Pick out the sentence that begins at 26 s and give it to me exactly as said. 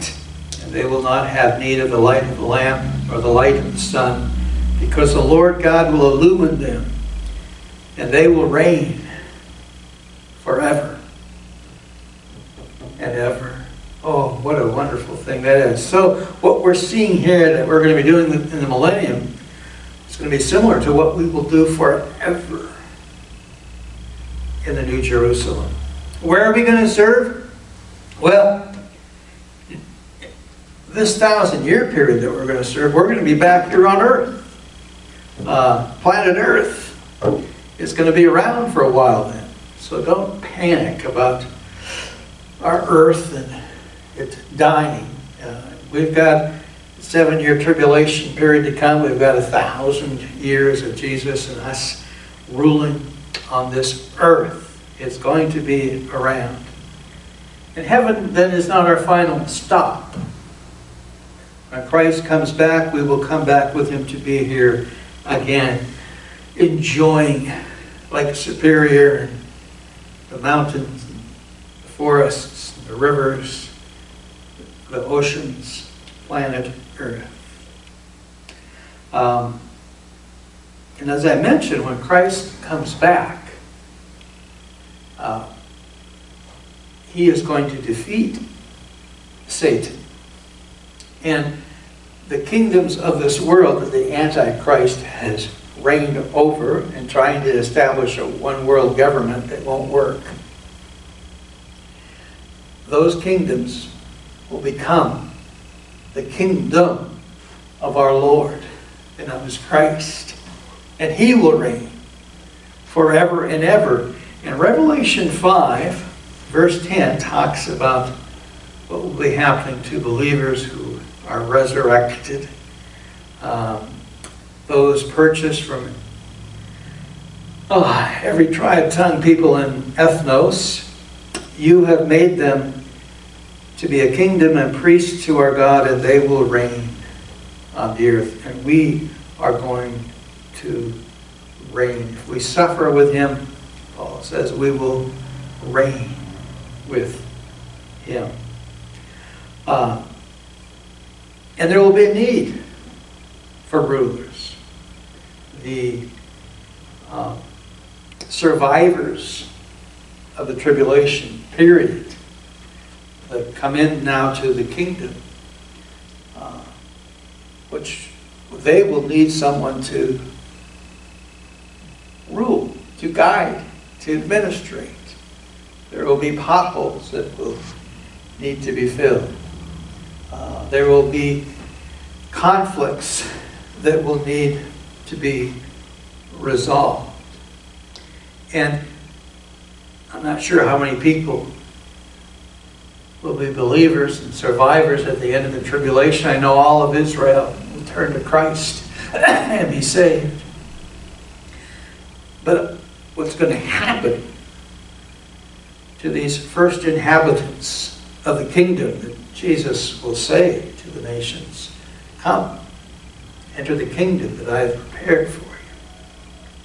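Where are we going to serve?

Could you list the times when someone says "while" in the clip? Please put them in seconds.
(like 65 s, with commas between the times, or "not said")
38 s.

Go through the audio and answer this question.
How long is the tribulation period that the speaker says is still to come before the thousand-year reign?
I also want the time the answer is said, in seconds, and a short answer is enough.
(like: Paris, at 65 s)
7 years, at 46 s.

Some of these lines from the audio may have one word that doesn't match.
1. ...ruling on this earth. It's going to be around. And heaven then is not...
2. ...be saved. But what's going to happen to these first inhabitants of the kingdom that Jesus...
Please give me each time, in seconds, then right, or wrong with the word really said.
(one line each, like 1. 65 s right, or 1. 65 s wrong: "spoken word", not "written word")
1. 52 s right
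2. 199 s right.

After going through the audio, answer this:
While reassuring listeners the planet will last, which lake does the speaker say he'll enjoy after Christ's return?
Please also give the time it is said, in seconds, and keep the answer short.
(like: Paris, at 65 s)
Lake Superior, at 68 s.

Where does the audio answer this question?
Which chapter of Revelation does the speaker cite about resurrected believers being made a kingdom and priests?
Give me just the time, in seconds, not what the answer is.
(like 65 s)
114 s.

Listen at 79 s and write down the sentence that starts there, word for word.
Um, and as I mentioned, when Christ comes back, uh, he is going to defeat Satan.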